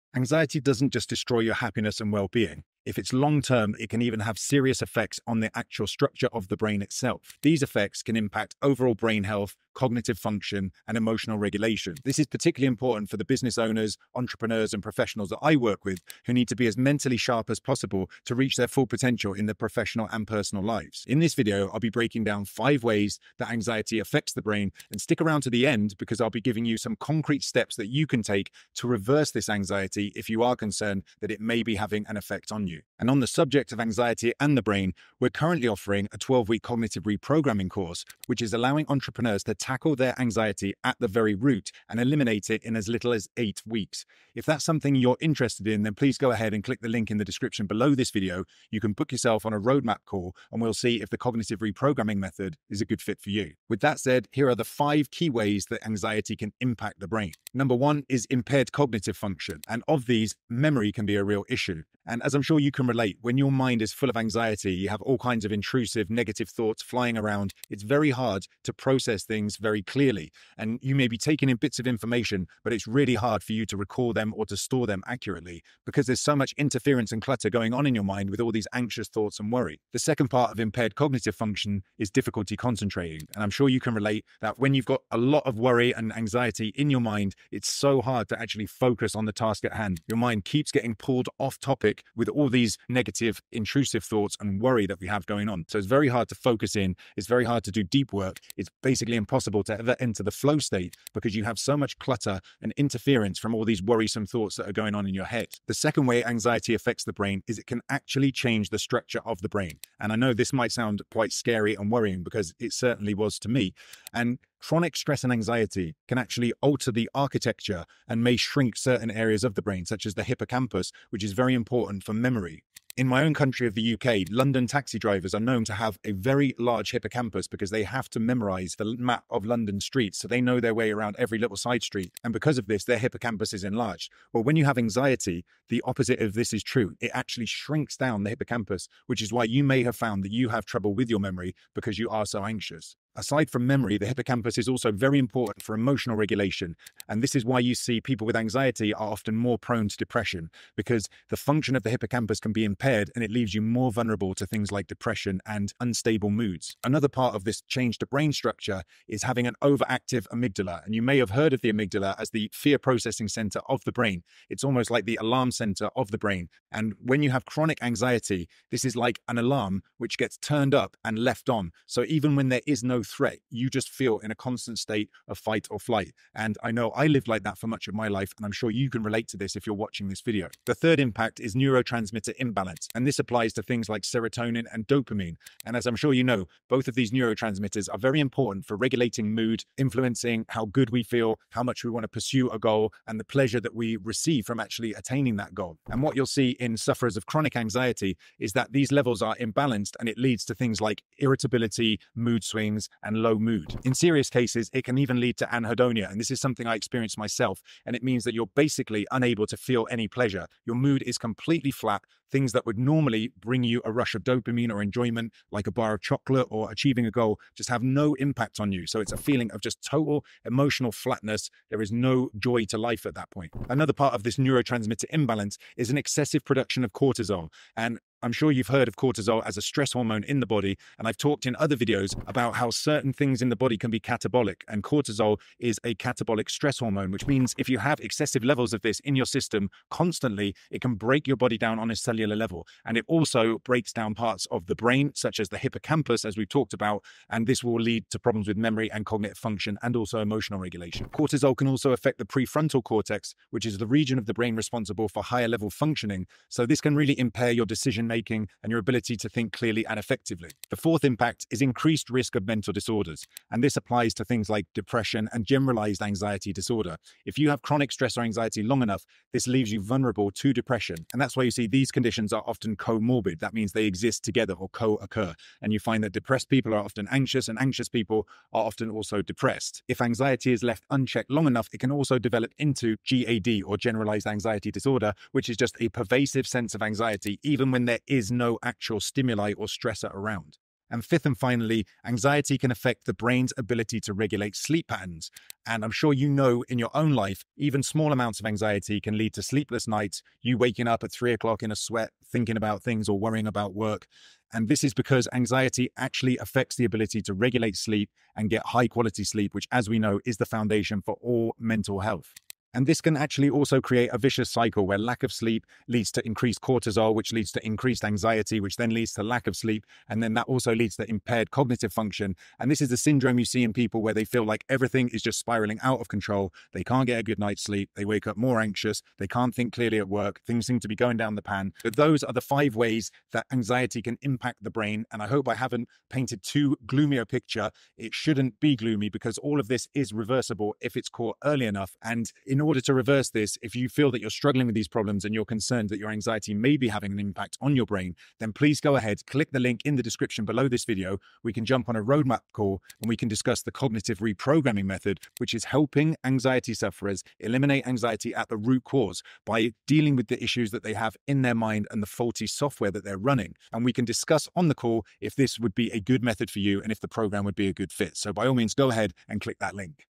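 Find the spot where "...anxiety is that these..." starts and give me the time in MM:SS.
03:17.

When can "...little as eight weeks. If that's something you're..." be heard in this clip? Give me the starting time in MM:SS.
00:42.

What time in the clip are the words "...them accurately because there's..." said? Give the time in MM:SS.
01:14.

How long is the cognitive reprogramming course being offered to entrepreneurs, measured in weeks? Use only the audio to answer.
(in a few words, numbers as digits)
12 weeks.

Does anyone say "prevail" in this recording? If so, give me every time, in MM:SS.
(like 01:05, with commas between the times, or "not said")
not said.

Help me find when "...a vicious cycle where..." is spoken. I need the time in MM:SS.
05:14.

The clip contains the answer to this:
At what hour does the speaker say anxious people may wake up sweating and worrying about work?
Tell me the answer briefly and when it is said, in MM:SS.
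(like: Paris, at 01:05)
3 o'clock, at 05:01.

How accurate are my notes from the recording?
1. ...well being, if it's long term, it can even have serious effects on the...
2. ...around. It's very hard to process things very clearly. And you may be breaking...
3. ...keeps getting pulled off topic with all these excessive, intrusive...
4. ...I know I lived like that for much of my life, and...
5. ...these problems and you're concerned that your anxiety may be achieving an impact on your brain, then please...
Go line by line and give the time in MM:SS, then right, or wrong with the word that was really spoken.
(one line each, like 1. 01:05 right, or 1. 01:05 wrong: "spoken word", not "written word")
1. 00:02 right
2. 01:07 wrong: "taking", not "breaking"
3. 01:30 wrong: "negative", not "excessive"
4. 02:56 right
5. 05:44 wrong: "having", not "achieving".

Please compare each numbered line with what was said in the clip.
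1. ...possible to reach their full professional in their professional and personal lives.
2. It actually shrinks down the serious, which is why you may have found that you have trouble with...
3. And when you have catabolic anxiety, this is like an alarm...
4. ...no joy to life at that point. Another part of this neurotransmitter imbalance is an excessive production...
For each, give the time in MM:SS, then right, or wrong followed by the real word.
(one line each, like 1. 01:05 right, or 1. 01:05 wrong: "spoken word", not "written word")
1. 00:17 wrong: "potential", not "professional"
2. 02:16 wrong: "hippocampus", not "serious"
3. 02:46 wrong: "chronic", not "catabolic"
4. 03:41 right.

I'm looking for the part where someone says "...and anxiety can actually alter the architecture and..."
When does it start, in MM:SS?
01:55.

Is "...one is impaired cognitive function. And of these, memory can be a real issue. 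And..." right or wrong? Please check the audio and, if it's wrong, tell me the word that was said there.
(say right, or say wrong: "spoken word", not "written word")
right.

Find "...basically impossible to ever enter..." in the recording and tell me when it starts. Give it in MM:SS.
01:38.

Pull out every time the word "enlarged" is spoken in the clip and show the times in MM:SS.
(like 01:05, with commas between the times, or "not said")
02:13.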